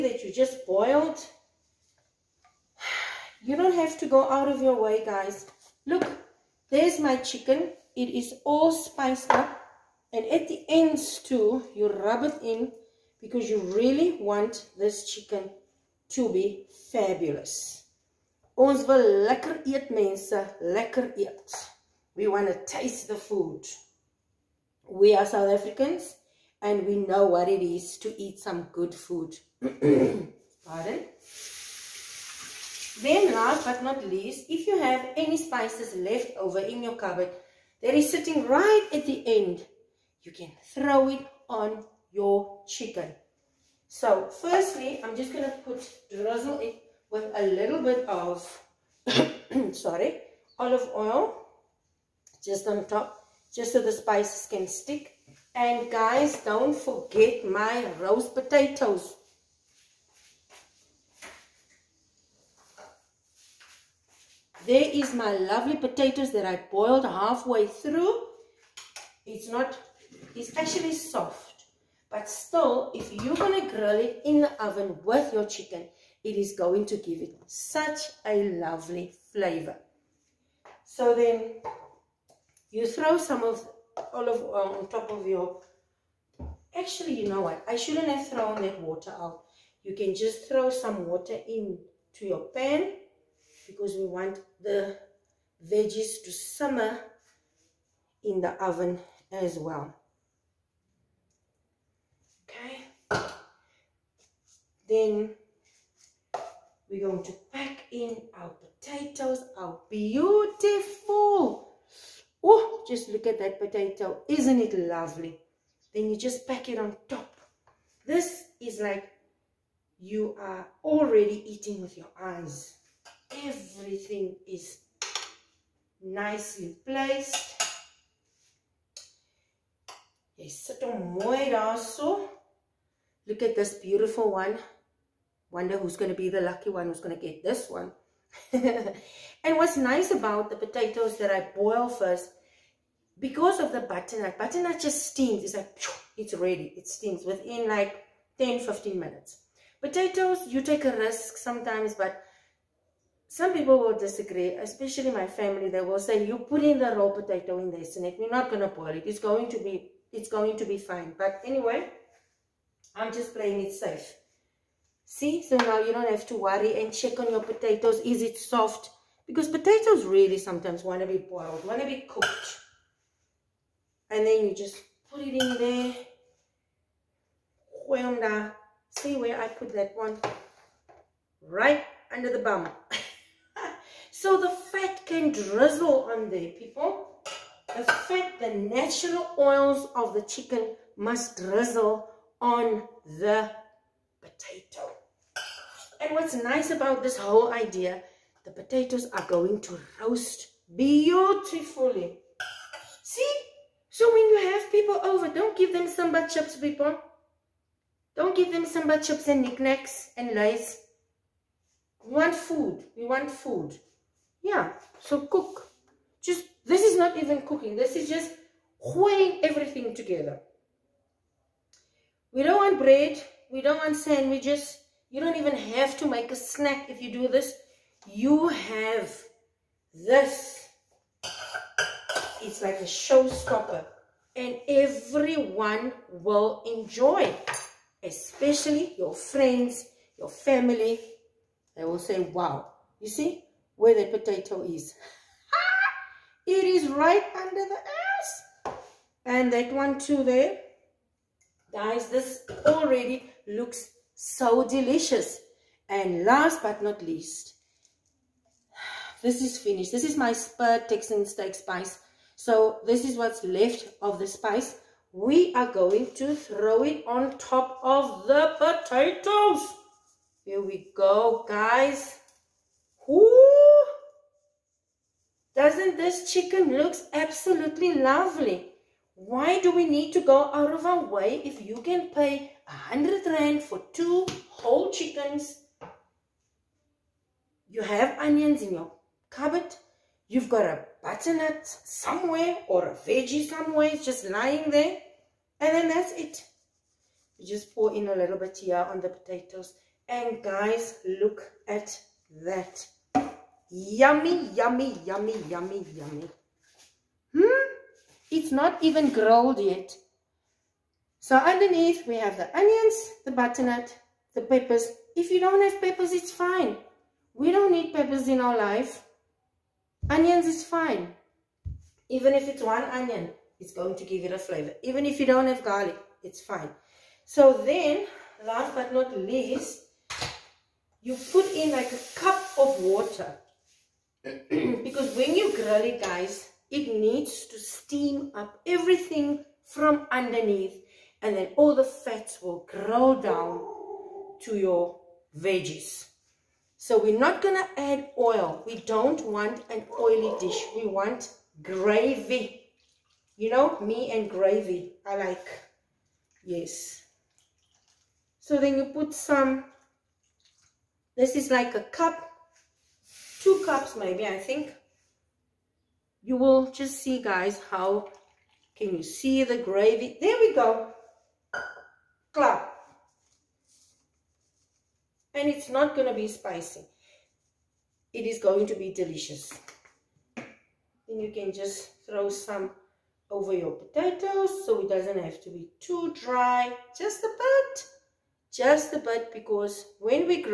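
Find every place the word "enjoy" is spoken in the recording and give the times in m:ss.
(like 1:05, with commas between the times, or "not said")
3:56.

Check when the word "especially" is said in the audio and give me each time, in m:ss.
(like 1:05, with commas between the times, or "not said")
2:34, 3:58.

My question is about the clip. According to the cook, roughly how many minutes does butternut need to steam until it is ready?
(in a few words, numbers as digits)
10 to 15 minutes.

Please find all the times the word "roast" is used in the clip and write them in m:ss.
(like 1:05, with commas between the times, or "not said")
0:57, 3:19.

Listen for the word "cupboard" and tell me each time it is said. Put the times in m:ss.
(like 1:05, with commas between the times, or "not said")
0:36, 4:49.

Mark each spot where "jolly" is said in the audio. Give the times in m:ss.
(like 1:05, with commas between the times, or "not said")
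not said.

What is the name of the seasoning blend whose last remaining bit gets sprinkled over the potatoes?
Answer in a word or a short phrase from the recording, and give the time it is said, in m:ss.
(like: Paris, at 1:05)
Spur Texan steak spice, at 4:20.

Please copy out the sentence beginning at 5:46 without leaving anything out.
So we're not going to add oil.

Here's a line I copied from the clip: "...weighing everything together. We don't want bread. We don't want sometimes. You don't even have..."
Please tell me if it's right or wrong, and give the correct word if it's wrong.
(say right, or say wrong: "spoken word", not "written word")
wrong: "sandwiches", not "sometimes".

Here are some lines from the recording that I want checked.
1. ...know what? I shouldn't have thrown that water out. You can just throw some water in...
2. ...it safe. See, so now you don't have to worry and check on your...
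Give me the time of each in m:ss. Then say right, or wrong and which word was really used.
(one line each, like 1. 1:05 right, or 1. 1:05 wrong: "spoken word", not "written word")
1. 1:27 right
2. 2:43 right.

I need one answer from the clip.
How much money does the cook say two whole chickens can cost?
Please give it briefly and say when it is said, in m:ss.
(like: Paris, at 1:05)
100 rand, at 4:42.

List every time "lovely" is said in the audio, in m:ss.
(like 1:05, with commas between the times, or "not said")
1:05, 1:18, 1:54, 4:37.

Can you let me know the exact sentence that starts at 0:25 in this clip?
We are South Africans and we know what it is to eat some good food.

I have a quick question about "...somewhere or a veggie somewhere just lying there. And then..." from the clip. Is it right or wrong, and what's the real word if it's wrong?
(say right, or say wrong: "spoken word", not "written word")
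right.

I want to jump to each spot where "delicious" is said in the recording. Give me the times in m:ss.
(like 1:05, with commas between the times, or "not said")
4:14, 6:18.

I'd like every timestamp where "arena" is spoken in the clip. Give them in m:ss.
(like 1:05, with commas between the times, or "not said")
not said.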